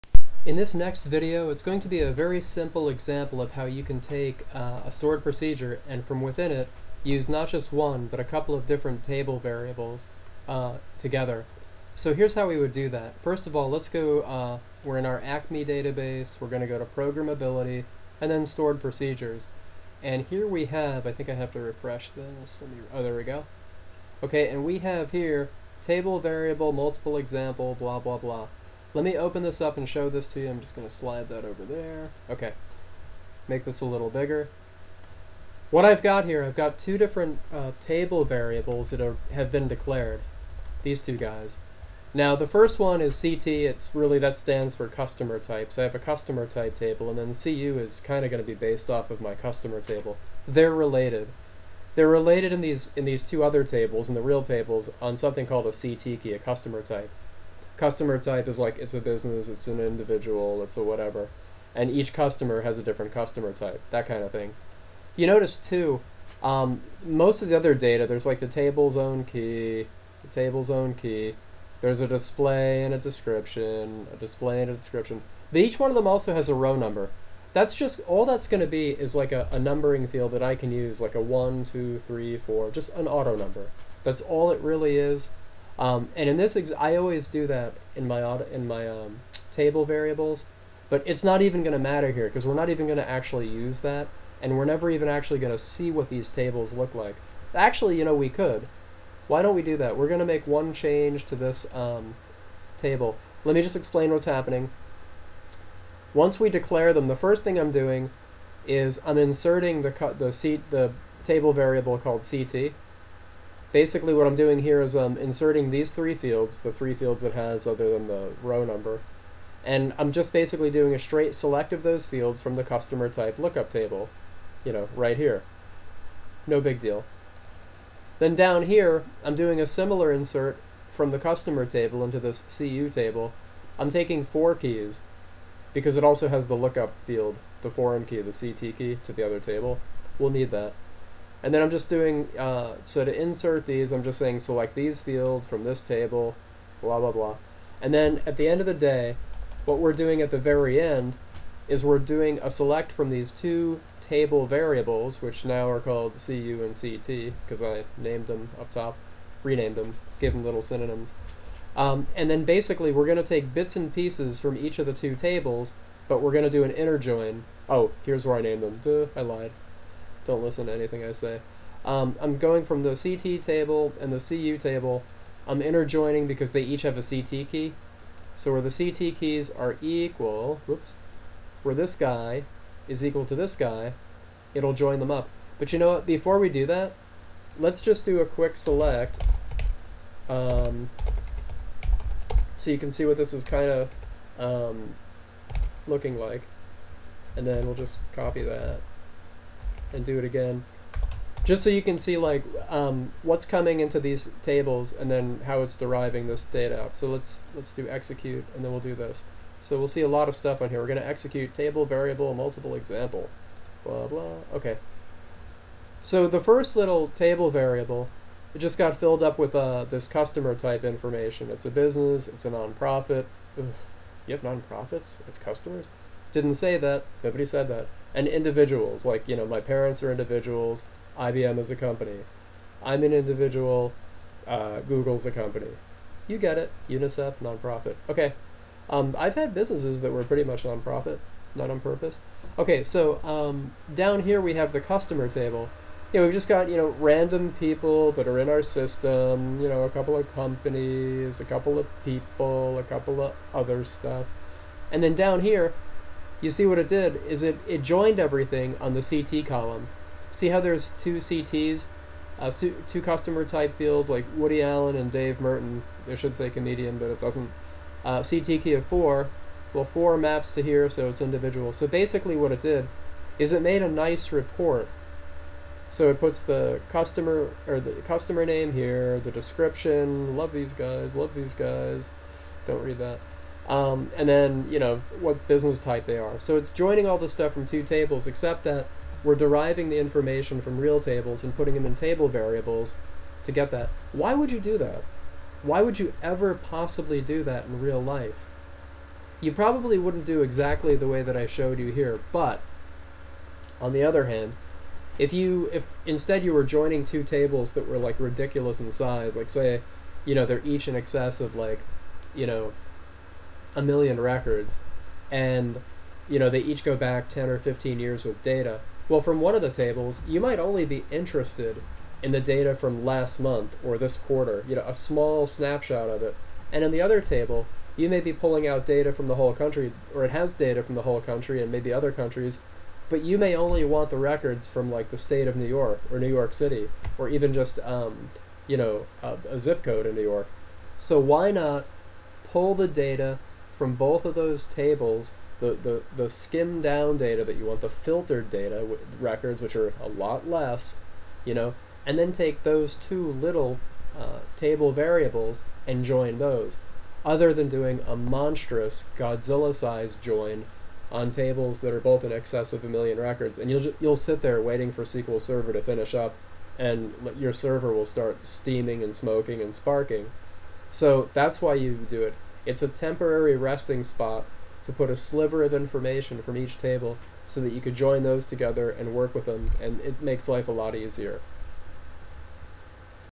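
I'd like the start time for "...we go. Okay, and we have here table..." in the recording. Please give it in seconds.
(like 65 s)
23 s.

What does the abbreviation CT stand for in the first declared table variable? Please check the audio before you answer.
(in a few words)
customer types.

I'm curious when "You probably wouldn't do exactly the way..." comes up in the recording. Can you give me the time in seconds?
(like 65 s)
299 s.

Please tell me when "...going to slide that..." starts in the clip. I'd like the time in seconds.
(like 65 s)
30 s.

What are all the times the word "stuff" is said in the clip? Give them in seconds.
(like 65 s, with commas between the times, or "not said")
210 s, 253 s, 287 s.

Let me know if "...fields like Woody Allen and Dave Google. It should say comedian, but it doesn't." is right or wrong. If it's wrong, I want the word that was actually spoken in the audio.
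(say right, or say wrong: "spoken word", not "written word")
wrong: "Merton", not "Google".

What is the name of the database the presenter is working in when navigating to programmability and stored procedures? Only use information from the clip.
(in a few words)
ACME.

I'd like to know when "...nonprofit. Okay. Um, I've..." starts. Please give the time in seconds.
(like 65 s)
237 s.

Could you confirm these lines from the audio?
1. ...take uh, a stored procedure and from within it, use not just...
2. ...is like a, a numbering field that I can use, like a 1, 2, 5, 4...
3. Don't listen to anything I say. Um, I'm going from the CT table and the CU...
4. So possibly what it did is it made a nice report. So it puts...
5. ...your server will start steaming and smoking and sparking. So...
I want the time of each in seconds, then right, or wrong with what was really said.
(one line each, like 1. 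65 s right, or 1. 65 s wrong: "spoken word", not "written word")
1. 4 s right
2. 78 s wrong: "3", not "5"
3. 170 s right
4. 271 s wrong: "basically", not "possibly"
5. 367 s right.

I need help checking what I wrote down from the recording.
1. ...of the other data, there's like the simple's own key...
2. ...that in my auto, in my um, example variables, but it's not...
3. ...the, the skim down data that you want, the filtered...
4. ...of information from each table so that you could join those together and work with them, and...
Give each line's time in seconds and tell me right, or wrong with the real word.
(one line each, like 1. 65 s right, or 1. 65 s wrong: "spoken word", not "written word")
1. 67 s wrong: "table", not "simple"
2. 87 s wrong: "table", not "example"
3. 345 s right
4. 375 s right.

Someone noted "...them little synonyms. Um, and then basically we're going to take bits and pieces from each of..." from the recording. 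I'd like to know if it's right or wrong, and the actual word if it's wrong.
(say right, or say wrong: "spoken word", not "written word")
right.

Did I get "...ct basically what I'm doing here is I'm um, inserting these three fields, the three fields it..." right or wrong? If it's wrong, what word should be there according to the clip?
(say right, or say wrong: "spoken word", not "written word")
right.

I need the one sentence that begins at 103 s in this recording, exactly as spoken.
Let me just explain what's happening.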